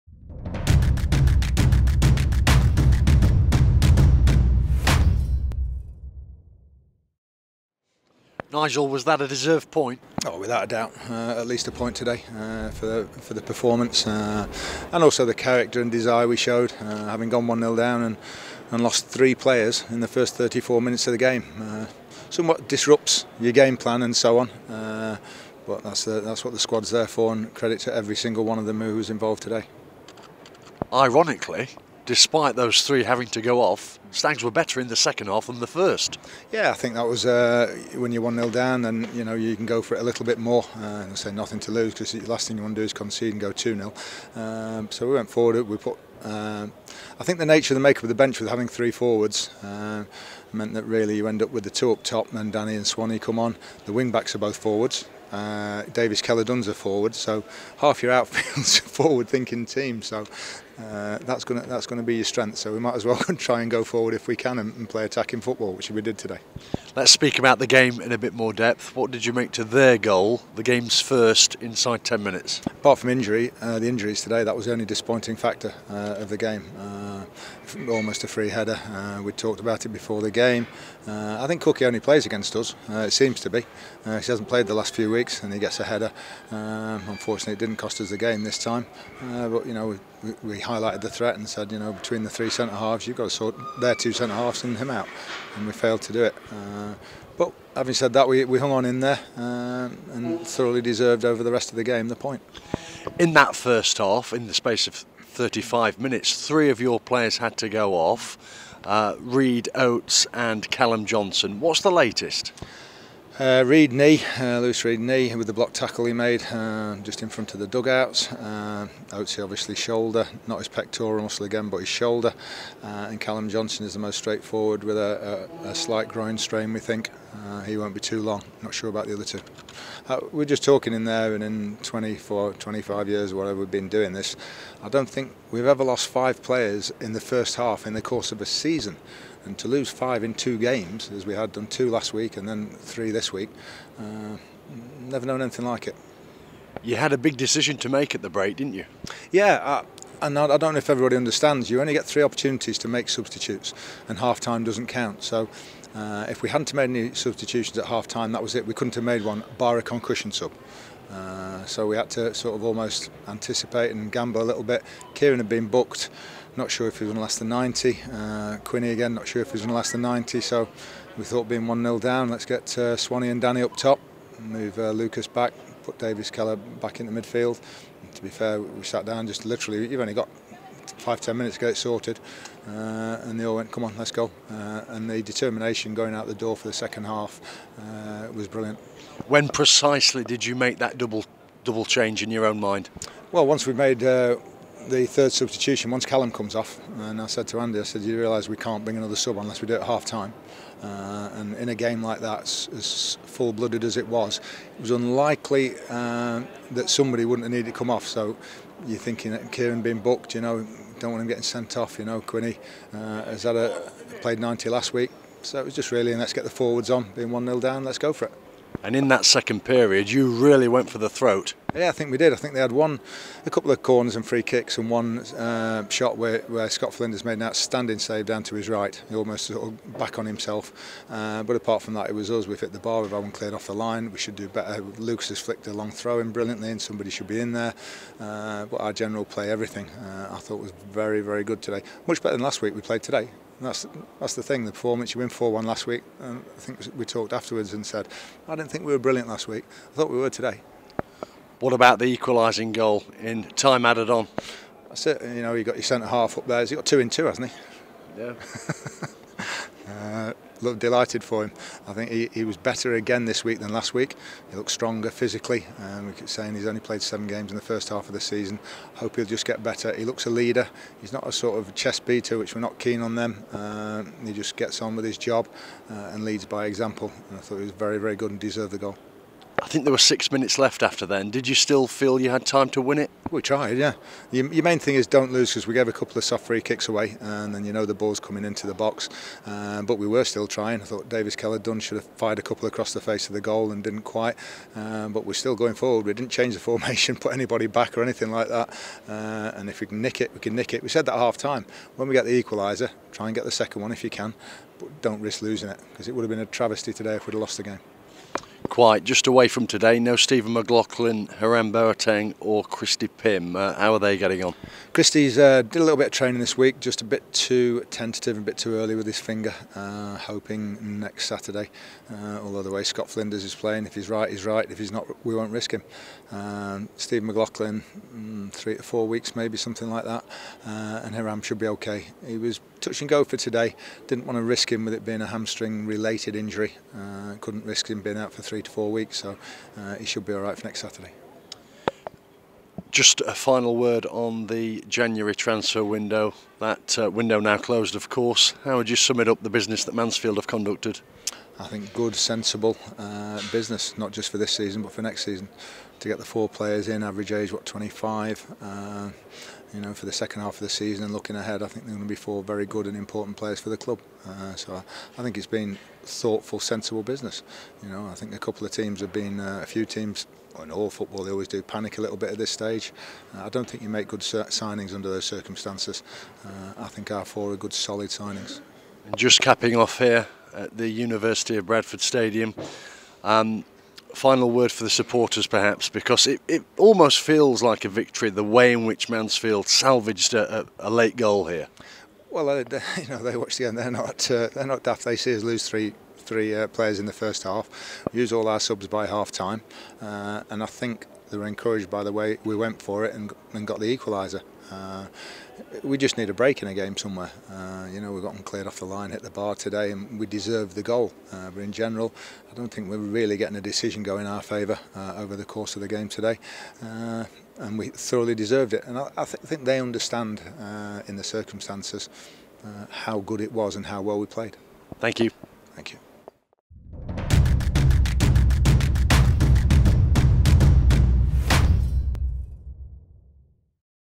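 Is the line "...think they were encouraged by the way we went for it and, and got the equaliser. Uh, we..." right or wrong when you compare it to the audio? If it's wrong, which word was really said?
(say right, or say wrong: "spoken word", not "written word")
right.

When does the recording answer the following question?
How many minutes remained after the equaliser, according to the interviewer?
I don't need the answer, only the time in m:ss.
4:39.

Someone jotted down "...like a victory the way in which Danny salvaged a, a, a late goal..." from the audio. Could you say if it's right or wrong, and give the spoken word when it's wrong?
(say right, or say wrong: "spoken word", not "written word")
wrong: "Mansfield", not "Danny".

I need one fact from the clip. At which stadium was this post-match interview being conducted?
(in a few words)
University of Bradford Stadium.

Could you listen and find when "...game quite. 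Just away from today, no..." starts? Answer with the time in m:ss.
5:07.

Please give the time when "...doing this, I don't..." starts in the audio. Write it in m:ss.
2:13.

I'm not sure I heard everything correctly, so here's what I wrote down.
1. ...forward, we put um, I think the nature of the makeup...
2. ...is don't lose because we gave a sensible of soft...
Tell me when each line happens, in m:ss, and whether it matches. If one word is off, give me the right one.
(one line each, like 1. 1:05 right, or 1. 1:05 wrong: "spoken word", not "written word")
1. 0:45 right
2. 4:44 wrong: "couple", not "sensible".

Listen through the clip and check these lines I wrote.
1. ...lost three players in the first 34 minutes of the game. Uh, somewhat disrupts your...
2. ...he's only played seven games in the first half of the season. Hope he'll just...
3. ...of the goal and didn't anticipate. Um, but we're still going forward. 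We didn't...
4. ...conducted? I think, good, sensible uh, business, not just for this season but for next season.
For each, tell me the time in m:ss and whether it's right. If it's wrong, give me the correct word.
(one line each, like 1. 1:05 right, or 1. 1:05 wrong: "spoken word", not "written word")
1. 0:18 right
2. 4:26 right
3. 4:53 wrong: "quite", not "anticipate"
4. 5:50 right.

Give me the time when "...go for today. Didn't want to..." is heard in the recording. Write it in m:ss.
5:33.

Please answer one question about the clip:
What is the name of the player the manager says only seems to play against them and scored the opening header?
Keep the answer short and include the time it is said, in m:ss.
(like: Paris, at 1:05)
Cookie, at 1:21.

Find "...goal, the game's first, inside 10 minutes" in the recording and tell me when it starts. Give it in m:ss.
1:09.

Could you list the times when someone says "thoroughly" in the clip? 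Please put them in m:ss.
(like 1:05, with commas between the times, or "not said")
1:40, 6:57.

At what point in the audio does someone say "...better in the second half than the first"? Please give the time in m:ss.
0:34.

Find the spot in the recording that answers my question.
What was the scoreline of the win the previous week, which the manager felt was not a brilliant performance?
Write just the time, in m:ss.
4:05.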